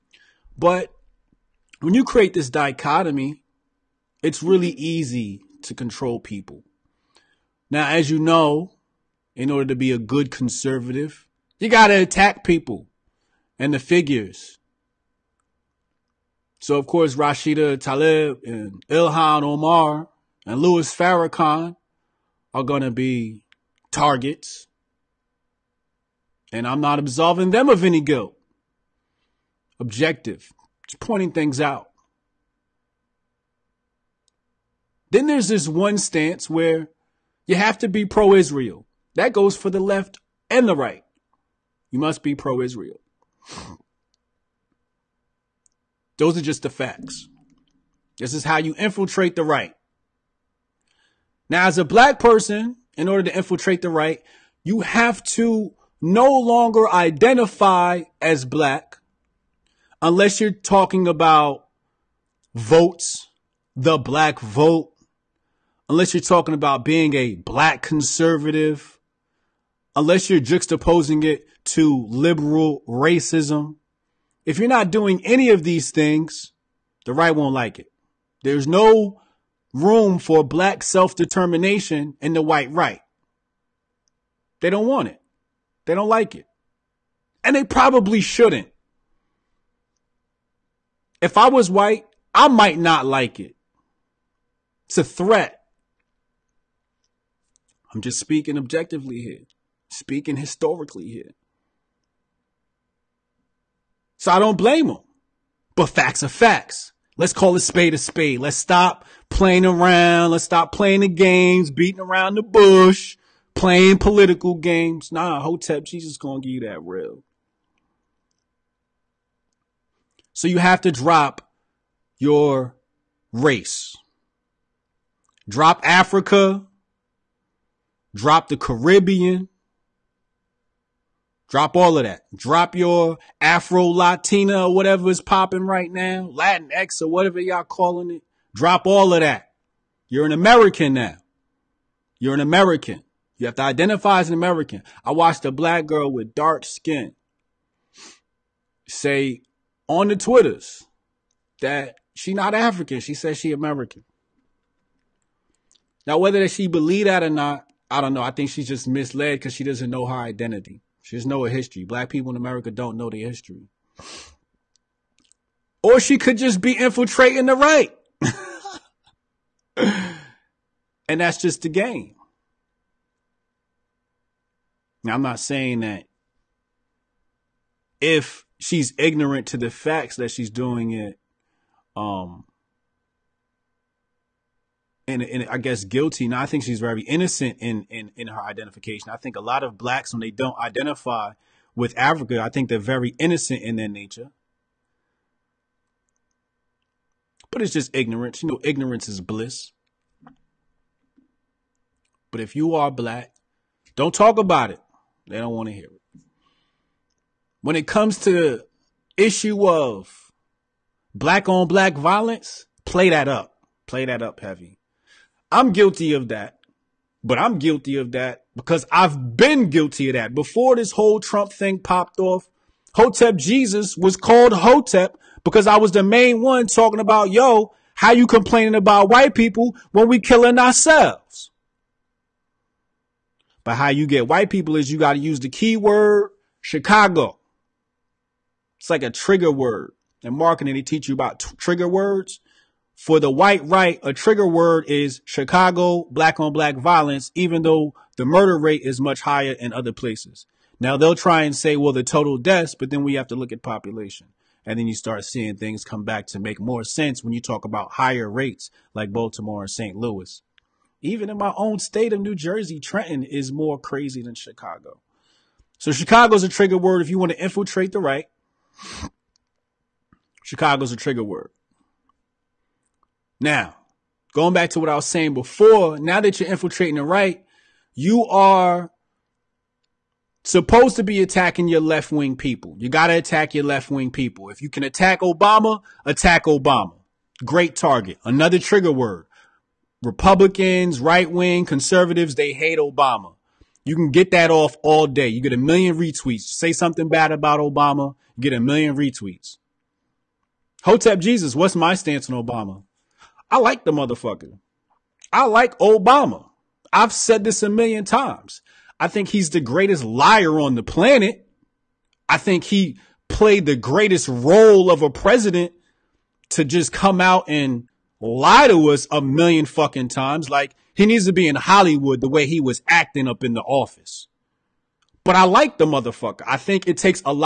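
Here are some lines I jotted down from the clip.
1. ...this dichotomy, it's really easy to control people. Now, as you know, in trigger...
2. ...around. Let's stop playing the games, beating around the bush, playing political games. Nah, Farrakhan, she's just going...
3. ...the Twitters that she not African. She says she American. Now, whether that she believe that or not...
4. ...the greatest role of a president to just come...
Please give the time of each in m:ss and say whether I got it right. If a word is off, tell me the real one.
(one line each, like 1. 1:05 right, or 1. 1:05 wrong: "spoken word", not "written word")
1. 0:02 wrong: "order", not "trigger"
2. 1:49 wrong: "Hotep", not "Farrakhan"
3. 2:30 right
4. 5:13 right.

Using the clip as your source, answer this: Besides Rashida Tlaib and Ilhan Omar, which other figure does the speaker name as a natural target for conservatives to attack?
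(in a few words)
Louis Farrakhan.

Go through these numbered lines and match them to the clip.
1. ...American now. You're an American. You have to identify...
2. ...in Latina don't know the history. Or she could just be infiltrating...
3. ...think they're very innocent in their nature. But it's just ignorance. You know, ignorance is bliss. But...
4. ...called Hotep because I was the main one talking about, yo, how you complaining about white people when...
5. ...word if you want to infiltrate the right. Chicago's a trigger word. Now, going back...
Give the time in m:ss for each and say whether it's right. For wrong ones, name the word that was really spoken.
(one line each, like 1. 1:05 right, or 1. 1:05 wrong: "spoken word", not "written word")
1. 2:20 right
2. 2:42 wrong: "America", not "Latina"
3. 3:12 right
4. 3:44 right
5. 4:26 right.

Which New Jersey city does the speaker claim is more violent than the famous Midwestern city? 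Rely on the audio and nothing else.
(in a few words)
Trenton.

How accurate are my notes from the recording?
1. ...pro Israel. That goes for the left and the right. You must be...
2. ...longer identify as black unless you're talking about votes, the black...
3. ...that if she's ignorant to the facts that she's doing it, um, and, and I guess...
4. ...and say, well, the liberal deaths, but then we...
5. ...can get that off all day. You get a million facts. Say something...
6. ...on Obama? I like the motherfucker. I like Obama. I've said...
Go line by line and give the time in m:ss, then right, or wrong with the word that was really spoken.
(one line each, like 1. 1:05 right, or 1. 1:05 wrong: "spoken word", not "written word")
1. 0:38 right
2. 0:56 right
3. 2:55 right
4. 4:11 wrong: "total", not "liberal"
5. 4:53 wrong: "retweets", not "facts"
6. 5:02 right.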